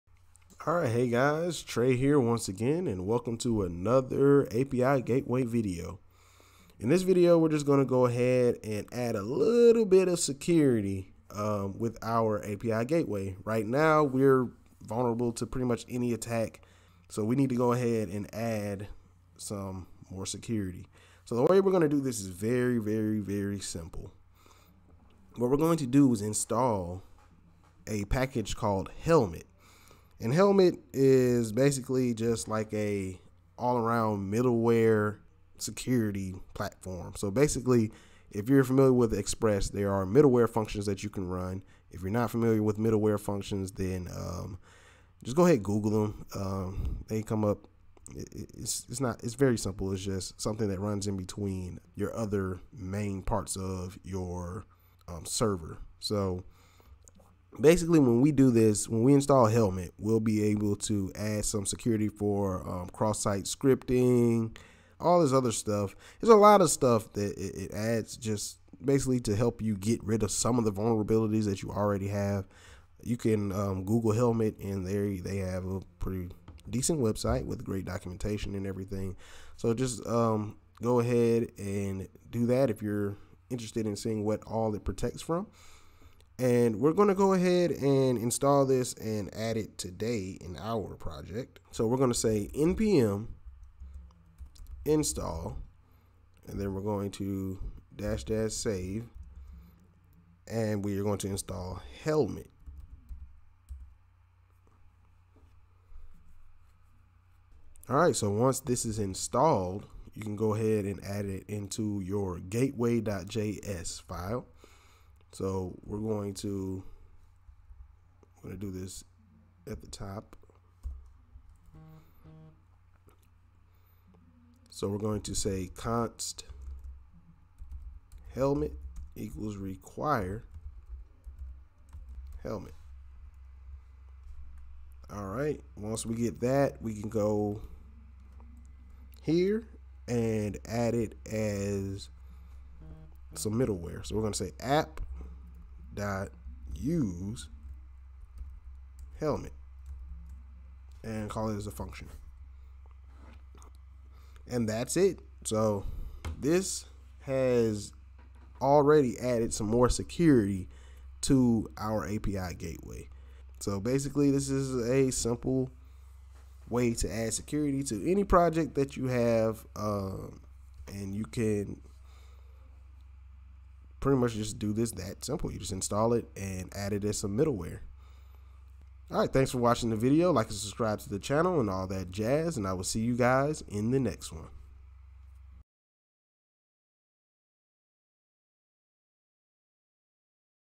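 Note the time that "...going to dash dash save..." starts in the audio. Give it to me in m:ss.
1:36.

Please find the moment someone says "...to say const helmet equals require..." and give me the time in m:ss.
2:05.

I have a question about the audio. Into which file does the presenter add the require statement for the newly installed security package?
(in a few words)
gateway.js.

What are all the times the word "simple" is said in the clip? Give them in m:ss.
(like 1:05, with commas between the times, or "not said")
0:23, 0:49, 2:45, 2:55.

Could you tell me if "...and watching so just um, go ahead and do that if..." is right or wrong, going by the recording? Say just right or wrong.
wrong.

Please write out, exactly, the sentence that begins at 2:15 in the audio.
Once we get that, we can go here and add it as some middleware.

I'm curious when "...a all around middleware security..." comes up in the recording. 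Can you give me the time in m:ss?
0:32.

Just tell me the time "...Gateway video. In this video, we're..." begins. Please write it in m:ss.
0:05.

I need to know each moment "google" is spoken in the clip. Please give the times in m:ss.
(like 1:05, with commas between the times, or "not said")
0:45, 1:13.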